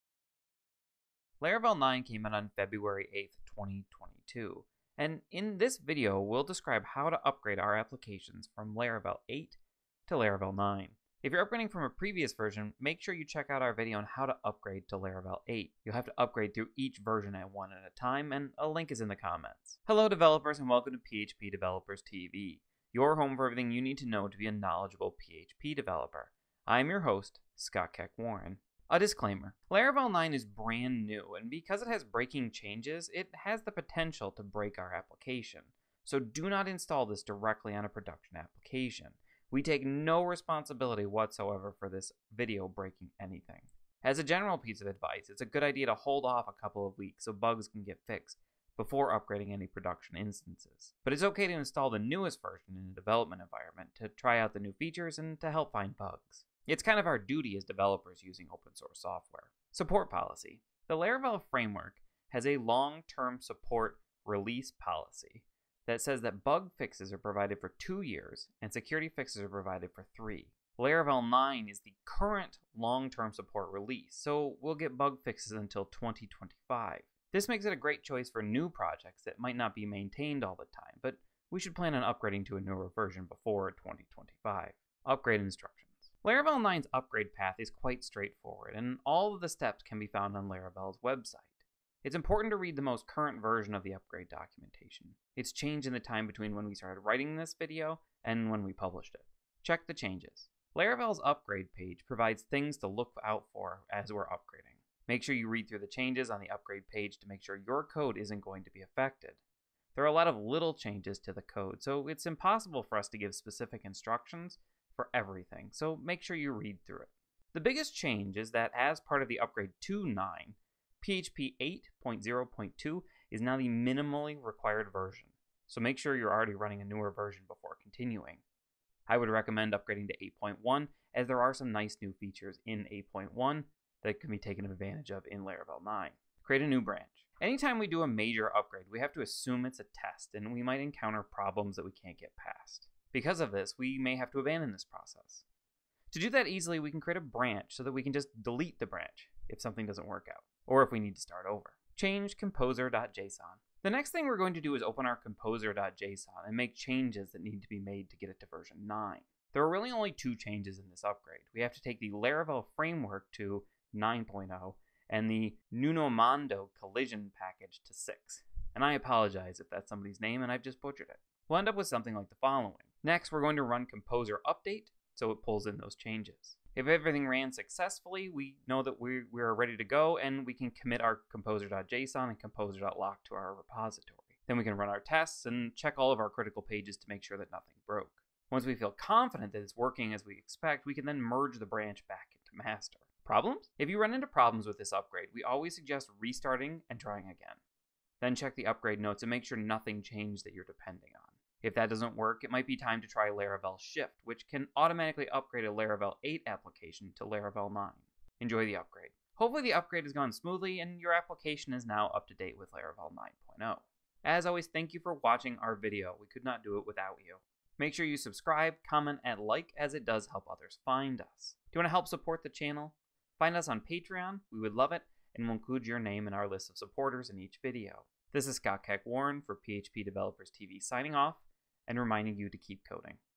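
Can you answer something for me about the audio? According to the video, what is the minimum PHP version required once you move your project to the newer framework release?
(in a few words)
8.0.2.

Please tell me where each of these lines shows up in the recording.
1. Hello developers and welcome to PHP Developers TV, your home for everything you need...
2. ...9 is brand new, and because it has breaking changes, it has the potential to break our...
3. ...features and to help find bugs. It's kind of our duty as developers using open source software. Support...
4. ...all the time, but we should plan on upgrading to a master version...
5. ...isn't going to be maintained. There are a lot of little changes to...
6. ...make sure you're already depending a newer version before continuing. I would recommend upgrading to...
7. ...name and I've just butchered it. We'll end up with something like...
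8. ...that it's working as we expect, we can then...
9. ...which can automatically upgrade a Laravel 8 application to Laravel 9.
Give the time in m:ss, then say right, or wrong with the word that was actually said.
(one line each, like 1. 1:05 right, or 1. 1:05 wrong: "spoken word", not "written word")
1. 0:19 right
2. 0:30 right
3. 0:54 right
4. 1:20 wrong: "newer", not "master"
5. 1:48 wrong: "affected", not "maintained"
6. 2:05 wrong: "running", not "depending"
7. 2:50 right
8. 3:09 right
9. 3:24 right.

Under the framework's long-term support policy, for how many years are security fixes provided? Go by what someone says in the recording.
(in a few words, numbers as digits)
3.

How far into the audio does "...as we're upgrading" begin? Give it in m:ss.
1:43.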